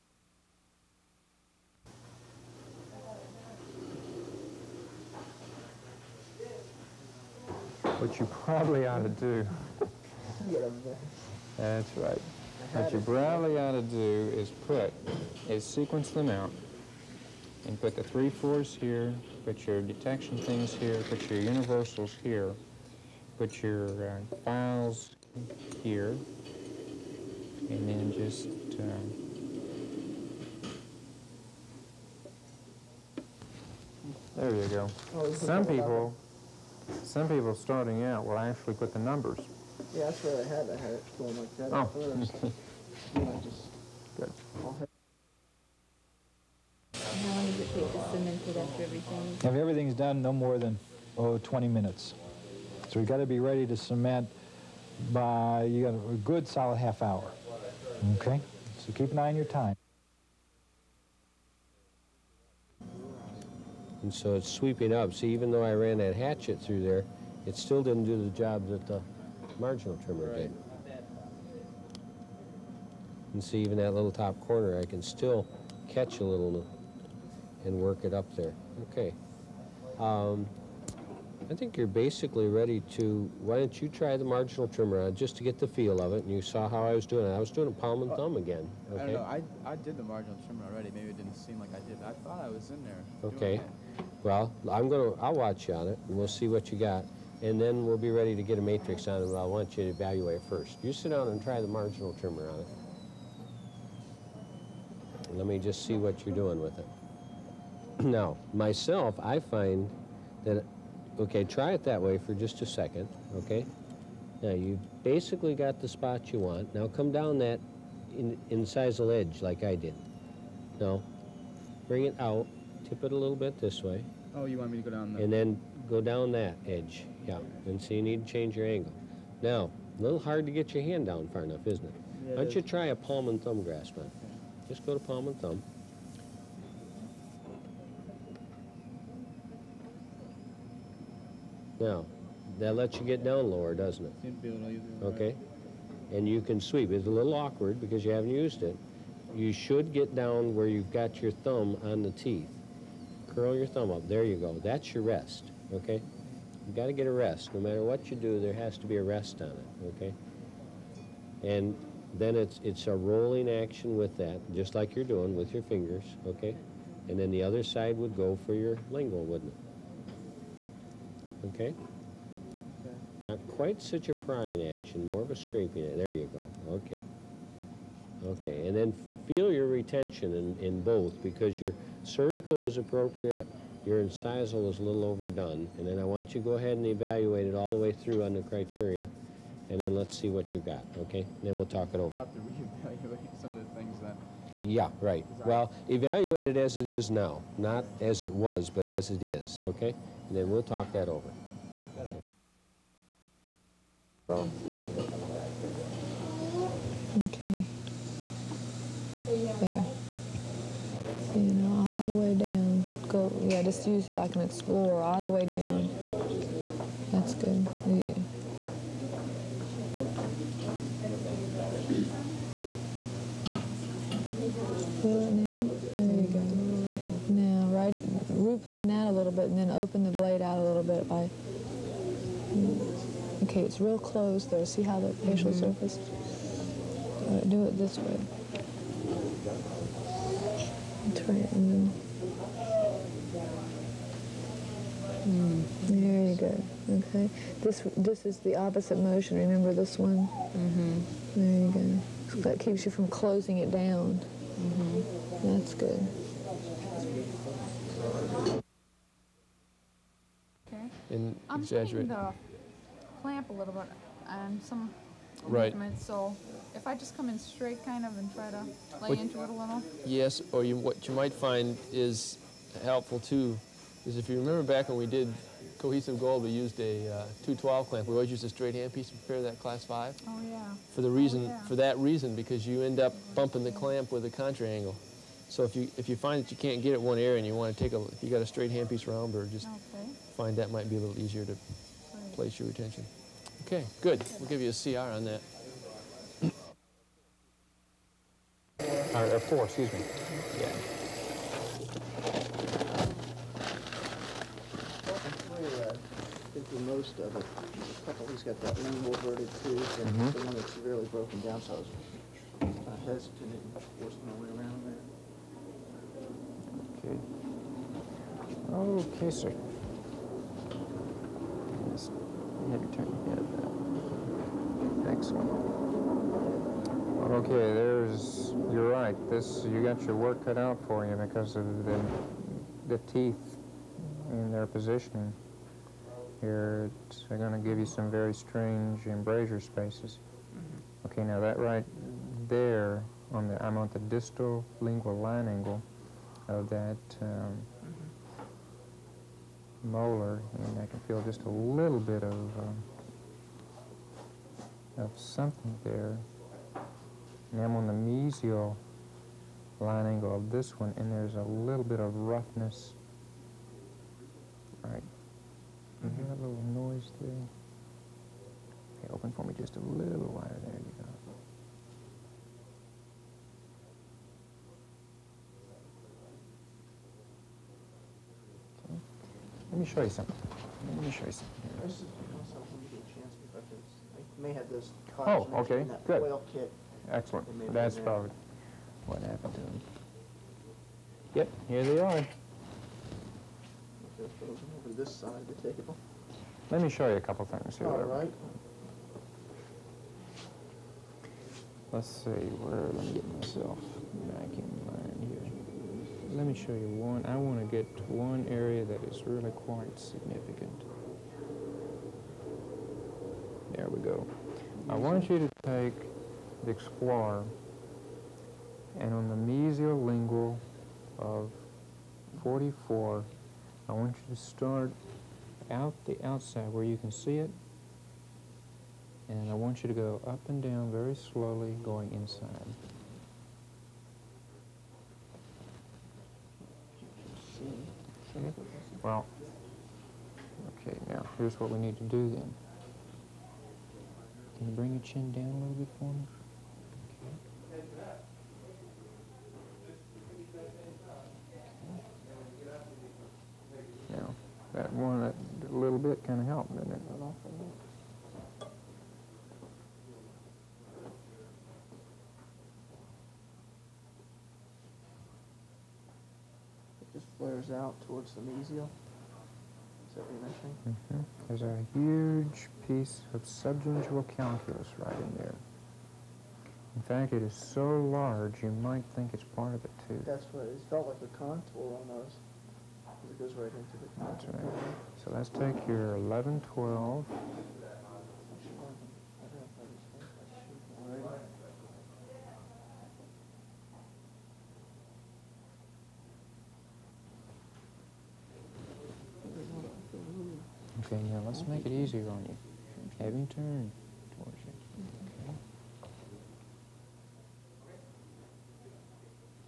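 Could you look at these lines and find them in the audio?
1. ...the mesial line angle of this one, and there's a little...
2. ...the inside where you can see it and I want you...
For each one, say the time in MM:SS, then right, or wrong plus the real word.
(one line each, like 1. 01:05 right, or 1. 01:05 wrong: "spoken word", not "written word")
1. 05:57 right
2. 07:06 wrong: "outside", not "inside".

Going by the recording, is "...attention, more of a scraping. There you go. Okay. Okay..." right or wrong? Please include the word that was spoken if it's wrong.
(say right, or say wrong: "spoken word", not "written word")
wrong: "action", not "attention".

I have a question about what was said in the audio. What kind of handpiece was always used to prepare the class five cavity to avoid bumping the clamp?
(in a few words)
straight hand piece.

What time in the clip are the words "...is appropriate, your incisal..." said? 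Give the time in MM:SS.
03:02.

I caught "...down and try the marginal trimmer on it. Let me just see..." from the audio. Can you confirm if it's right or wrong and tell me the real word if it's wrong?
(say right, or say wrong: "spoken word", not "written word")
right.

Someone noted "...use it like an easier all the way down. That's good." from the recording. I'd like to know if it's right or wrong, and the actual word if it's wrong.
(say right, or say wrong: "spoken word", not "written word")
wrong: "explorer", not "easier".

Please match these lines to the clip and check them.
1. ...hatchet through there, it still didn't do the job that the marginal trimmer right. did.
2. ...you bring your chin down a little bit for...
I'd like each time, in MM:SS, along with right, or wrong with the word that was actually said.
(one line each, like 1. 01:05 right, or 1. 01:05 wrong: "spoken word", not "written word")
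1. 01:06 right
2. 07:24 right.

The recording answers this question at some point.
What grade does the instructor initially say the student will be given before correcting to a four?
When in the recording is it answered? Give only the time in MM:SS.
04:54.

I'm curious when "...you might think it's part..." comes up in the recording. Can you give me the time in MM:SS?
07:58.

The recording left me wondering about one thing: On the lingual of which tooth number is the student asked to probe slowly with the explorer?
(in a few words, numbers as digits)
44.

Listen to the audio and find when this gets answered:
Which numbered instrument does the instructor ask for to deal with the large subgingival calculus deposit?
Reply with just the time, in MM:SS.
08:06.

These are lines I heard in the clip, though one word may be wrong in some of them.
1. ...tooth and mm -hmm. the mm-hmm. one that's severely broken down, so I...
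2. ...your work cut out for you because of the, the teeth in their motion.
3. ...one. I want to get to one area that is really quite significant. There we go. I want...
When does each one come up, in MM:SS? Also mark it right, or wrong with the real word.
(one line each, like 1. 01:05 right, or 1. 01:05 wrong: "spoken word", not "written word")
1. 05:09 right
2. 05:30 wrong: "position", not "motion"
3. 06:46 right.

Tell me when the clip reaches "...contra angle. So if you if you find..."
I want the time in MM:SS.
04:44.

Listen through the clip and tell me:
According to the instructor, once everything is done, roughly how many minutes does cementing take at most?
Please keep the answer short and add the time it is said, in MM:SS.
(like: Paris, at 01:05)
20 minutes, at 00:51.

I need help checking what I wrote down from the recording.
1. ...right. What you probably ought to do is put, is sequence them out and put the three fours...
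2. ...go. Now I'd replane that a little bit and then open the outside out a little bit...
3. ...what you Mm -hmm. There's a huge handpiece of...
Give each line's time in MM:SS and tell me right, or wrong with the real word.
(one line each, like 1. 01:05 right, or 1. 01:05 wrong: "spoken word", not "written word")
1. 00:11 right
2. 03:46 wrong: "blade", not "outside"
3. 07:50 wrong: "piece", not "handpiece".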